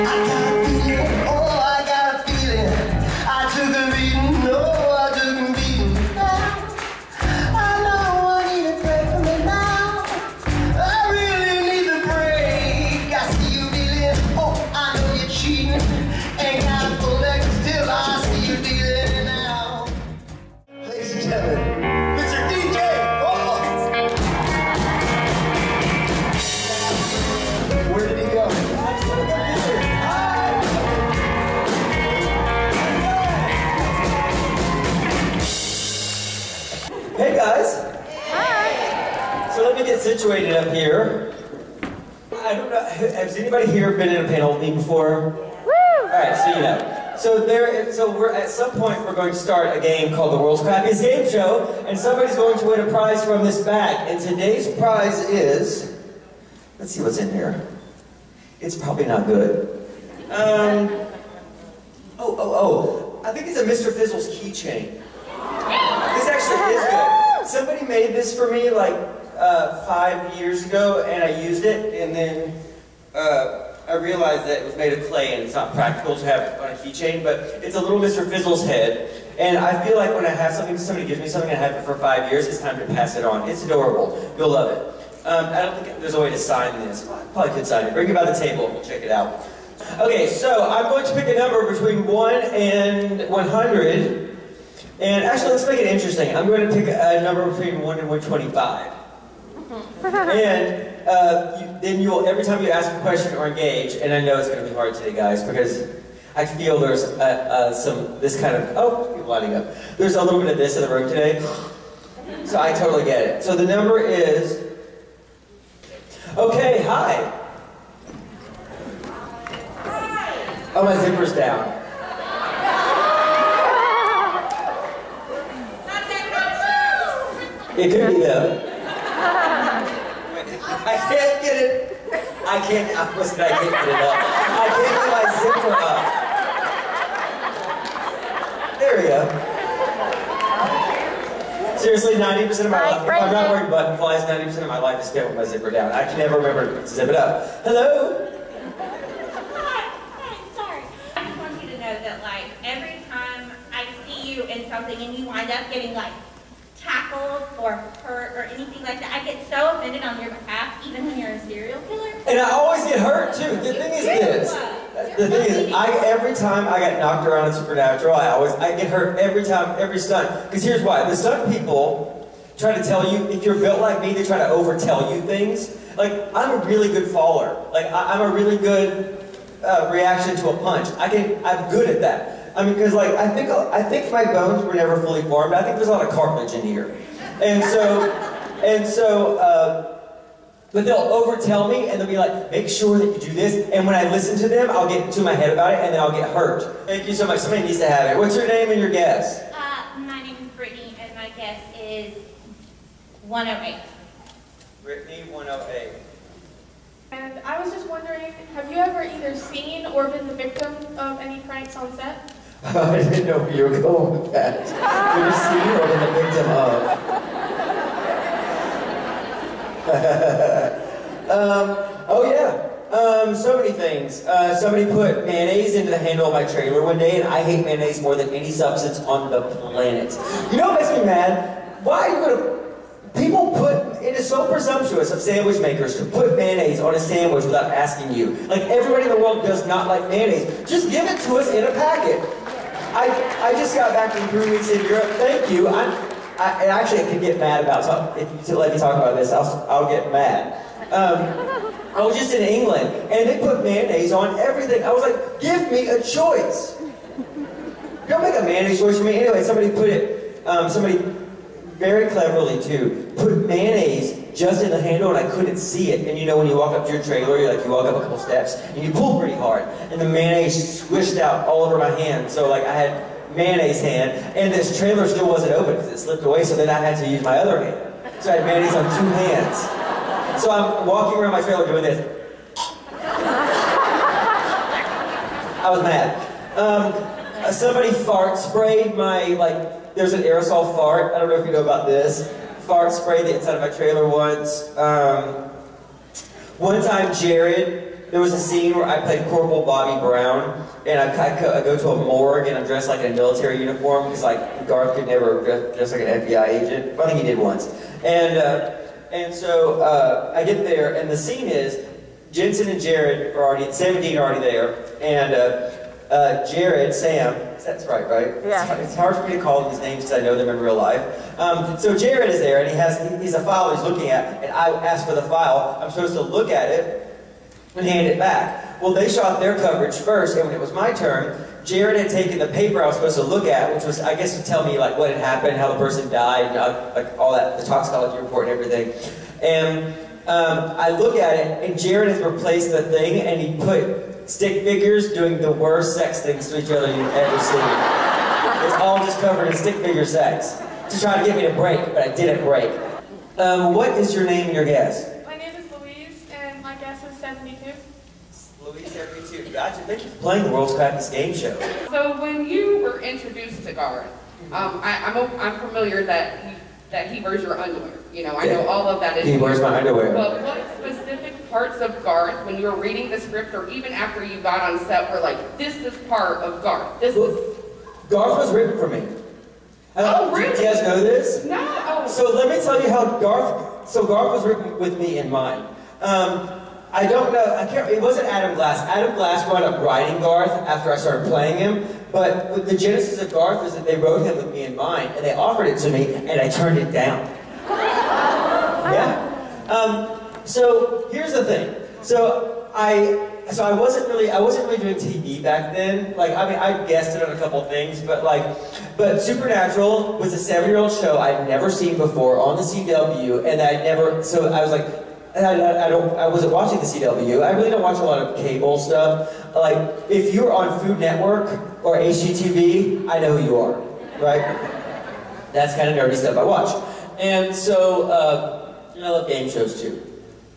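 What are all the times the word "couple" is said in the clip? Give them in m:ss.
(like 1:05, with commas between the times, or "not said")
4:28, 6:47.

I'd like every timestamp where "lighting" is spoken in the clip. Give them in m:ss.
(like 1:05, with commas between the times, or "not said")
1:49.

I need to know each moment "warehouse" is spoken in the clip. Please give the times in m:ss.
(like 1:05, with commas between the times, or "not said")
not said.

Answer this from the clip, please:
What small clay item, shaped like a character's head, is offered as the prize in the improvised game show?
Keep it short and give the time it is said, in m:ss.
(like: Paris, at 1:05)
Mr. Fizzles keychain, at 1:03.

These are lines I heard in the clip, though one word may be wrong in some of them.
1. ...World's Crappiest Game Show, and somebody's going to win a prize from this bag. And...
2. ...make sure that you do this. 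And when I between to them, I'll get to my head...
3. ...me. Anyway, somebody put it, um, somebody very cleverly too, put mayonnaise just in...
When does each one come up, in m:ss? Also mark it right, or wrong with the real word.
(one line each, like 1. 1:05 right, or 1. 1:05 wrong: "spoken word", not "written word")
1. 0:50 right
2. 3:12 wrong: "listen", not "between"
3. 4:19 right.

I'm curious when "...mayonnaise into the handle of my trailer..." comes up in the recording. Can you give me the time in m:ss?
3:45.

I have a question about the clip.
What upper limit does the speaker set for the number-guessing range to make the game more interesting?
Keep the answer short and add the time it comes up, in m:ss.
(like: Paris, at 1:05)
125, at 1:38.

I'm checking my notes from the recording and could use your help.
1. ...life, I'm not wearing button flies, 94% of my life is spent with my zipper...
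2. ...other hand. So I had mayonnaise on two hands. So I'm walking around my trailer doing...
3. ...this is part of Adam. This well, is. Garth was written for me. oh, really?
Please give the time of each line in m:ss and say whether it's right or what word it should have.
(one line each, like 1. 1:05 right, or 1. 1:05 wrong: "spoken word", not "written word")
1. 2:22 wrong: "90", not "94"
2. 4:37 right
3. 6:15 wrong: "Garth", not "Adam".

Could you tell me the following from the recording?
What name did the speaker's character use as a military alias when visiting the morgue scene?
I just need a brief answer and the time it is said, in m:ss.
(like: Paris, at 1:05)
Corporal Bobby Brown, at 4:59.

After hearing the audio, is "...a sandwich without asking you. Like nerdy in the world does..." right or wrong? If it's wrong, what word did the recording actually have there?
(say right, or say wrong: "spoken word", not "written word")
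wrong: "everybody", not "nerdy".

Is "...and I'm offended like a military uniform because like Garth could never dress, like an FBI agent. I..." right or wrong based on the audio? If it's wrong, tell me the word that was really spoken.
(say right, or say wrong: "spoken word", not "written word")
wrong: "dressed", not "offended".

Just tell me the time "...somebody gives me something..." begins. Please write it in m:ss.
1:20.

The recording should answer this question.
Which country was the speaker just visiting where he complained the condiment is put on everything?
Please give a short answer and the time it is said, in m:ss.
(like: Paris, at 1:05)
England, at 4:12.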